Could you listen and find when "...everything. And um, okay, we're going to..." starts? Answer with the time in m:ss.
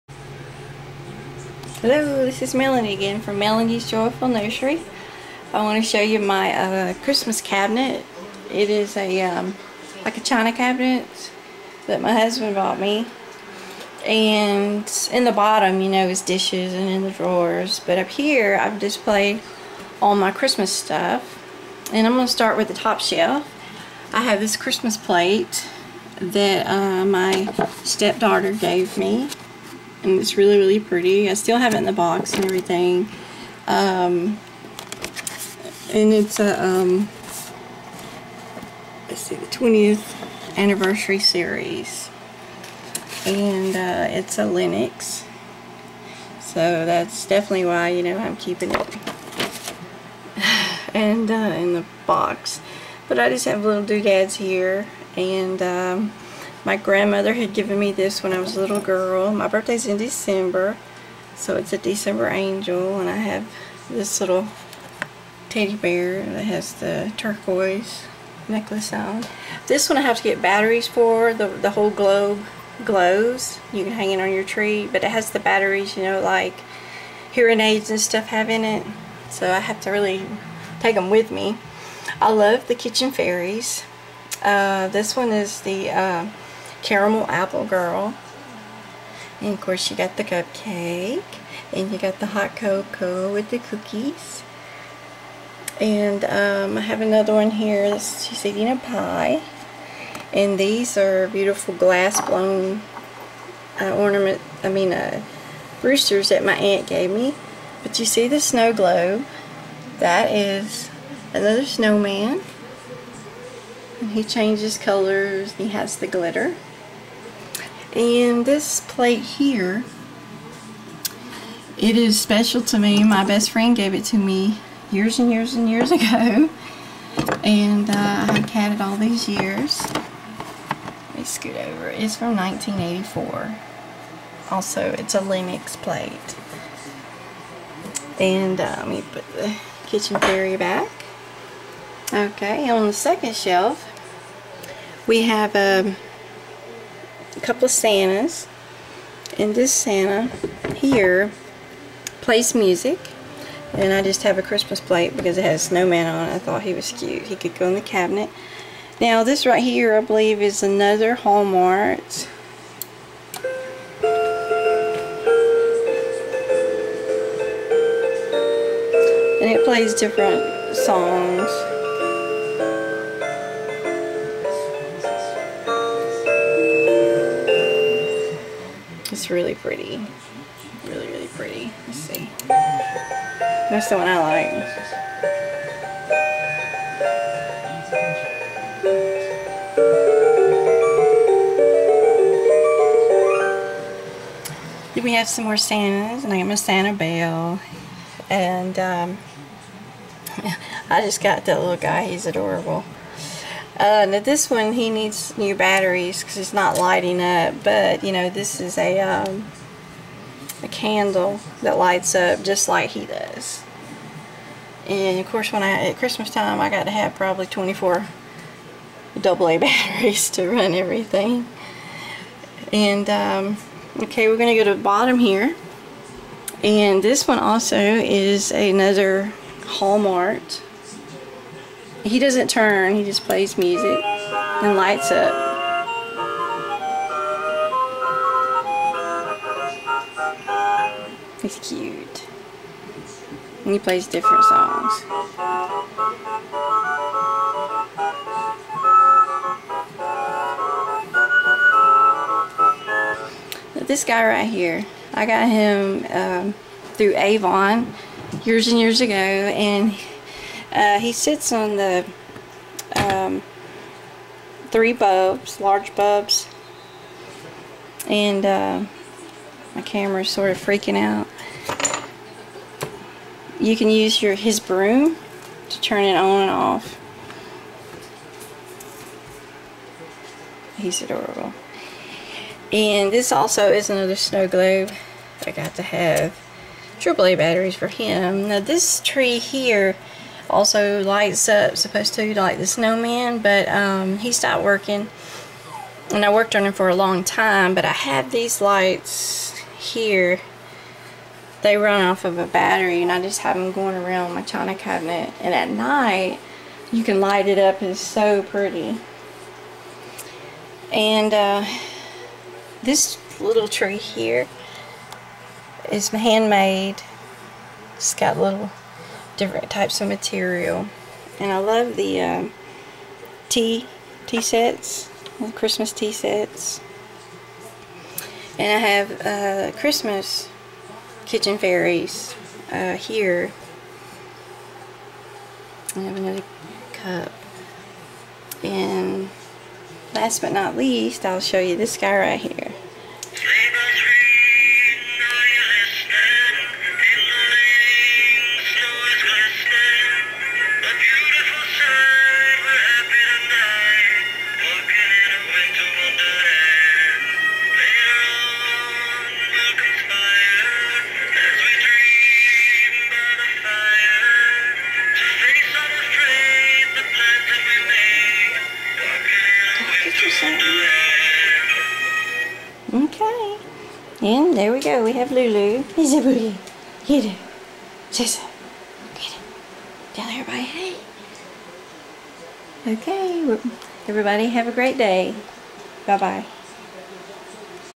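3:40.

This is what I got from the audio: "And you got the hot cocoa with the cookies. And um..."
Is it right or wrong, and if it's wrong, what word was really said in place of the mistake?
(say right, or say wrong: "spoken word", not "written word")
right.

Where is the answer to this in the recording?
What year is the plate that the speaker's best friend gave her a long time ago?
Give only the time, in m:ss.
2:12.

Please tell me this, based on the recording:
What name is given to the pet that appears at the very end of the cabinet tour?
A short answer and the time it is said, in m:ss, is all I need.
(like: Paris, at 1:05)
Lulu, at 6:15.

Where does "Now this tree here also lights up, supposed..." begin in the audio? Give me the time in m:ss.
4:48.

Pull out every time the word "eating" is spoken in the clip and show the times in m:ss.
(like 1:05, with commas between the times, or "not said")
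1:38.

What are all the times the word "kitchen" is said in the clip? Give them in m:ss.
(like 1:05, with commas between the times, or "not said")
1:22, 2:19, 5:31.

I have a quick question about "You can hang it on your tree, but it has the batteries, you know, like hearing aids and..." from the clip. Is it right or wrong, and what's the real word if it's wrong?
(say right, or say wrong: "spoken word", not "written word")
right.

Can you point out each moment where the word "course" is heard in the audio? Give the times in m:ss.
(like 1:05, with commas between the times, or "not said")
1:29, 3:35.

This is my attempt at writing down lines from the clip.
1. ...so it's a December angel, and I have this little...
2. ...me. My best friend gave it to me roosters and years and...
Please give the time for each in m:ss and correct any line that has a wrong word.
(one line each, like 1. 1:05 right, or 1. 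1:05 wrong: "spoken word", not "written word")
1. 1:01 right
2. 2:02 wrong: "years", not "roosters".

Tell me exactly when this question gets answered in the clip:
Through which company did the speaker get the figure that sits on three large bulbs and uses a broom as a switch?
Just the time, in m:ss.
4:17.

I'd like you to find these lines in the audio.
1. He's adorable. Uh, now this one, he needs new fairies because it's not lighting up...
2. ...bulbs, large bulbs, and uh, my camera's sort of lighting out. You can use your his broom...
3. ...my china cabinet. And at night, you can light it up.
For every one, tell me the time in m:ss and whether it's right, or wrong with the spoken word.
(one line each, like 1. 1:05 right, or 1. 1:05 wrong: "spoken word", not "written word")
1. 3:22 wrong: "batteries", not "fairies"
2. 4:24 wrong: "freaking", not "lighting"
3. 5:04 right.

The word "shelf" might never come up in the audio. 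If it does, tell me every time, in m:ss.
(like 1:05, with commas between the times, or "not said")
0:22, 2:23.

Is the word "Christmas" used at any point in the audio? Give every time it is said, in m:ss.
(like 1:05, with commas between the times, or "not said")
0:07, 0:20, 0:24, 2:34, 3:35, 5:25, 5:29.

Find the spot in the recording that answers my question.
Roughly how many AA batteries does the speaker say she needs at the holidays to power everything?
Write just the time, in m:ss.
3:37.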